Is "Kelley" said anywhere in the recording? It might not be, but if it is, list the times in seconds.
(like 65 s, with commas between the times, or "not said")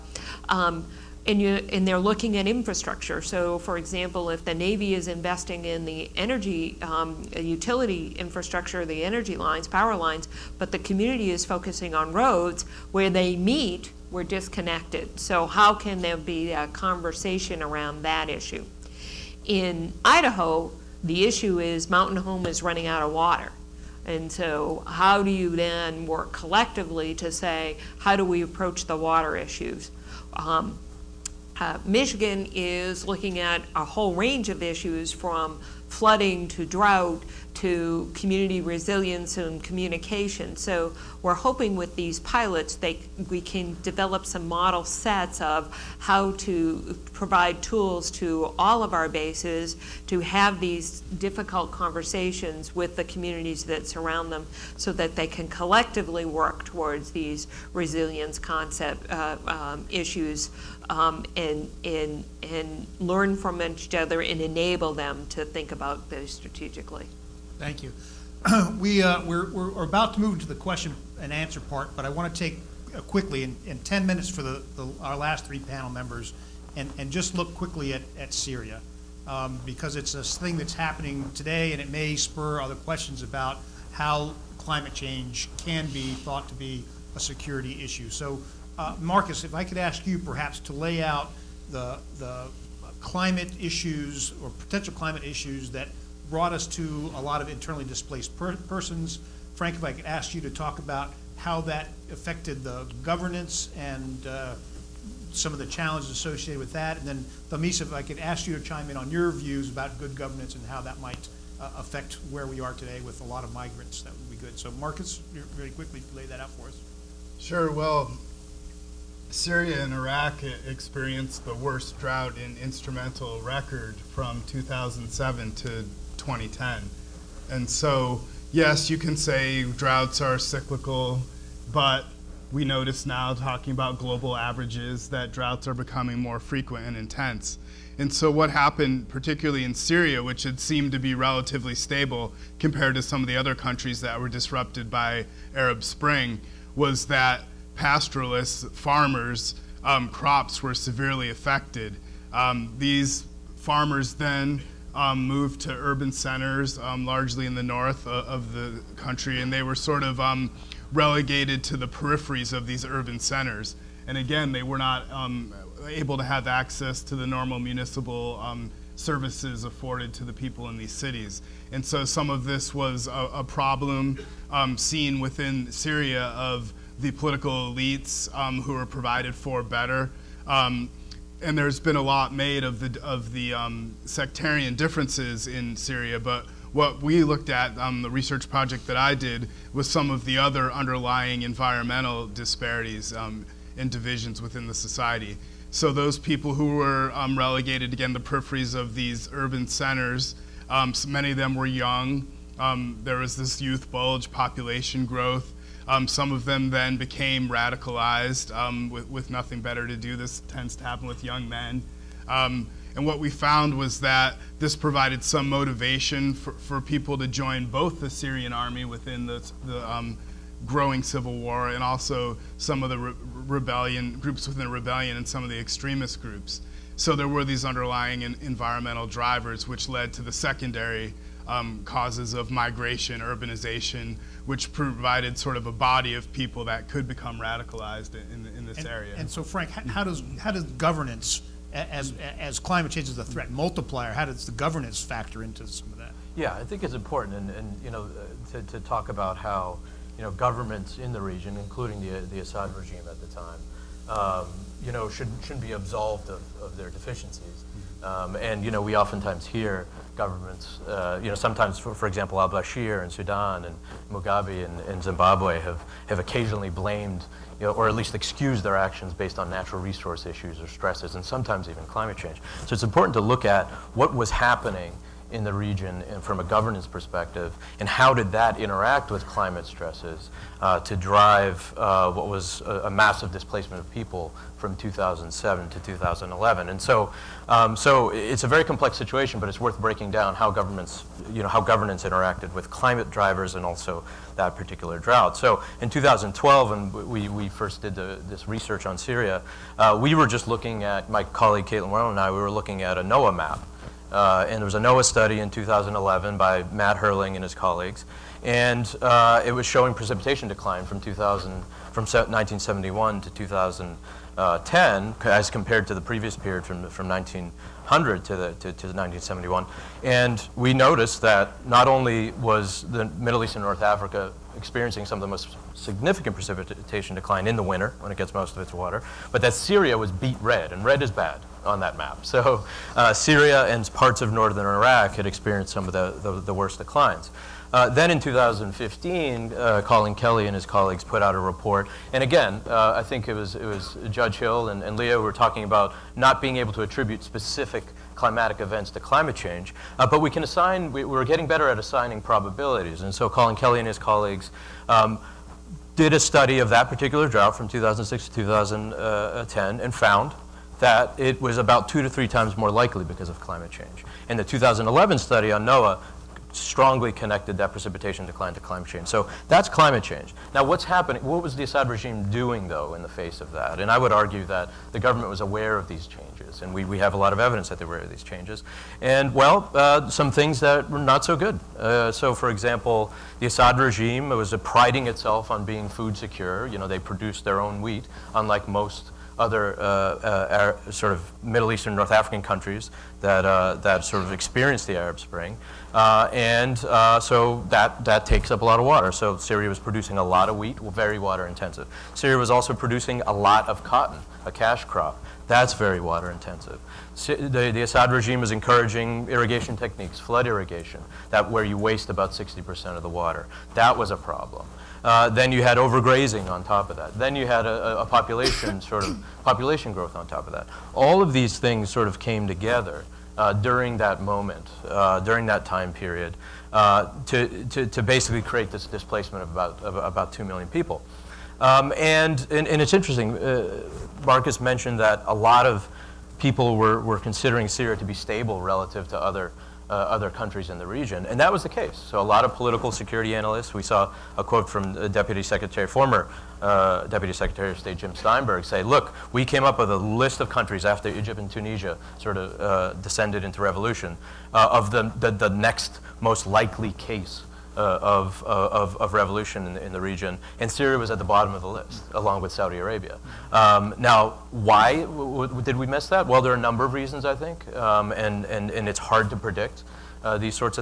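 340 s, 353 s.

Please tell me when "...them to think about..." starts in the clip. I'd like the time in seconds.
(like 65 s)
64 s.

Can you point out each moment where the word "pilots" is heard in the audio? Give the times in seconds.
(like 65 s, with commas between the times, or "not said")
42 s.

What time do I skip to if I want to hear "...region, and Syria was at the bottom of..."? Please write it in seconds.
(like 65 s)
460 s.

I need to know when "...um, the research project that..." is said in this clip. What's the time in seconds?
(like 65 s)
187 s.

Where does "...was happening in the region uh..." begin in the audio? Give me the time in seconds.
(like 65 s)
274 s.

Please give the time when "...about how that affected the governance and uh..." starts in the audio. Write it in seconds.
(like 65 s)
100 s.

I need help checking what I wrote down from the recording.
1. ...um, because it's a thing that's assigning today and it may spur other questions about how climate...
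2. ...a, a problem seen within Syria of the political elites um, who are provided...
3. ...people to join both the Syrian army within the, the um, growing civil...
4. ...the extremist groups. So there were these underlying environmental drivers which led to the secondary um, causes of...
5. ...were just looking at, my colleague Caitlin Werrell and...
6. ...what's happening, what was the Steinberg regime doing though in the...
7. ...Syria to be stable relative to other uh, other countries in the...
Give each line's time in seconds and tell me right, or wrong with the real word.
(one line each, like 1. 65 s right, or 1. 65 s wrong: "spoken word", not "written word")
1. 79 s wrong: "happening", not "assigning"
2. 173 s right
3. 216 s right
4. 225 s right
5. 300 s right
6. 370 s wrong: "Assad", not "Steinberg"
7. 437 s right.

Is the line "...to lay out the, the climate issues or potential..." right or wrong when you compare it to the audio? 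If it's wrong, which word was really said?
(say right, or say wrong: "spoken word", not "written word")
right.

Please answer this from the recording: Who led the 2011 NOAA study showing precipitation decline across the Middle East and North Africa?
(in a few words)
Matt Hoerling.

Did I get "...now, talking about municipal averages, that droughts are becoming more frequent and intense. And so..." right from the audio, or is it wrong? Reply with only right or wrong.
wrong.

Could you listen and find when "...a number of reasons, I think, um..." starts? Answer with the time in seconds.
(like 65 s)
466 s.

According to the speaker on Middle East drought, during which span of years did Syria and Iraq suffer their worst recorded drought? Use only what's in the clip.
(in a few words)
2007 to 2010.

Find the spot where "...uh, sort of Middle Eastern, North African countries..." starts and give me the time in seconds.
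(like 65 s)
389 s.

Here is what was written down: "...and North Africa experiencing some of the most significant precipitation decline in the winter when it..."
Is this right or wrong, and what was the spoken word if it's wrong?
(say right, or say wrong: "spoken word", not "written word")
right.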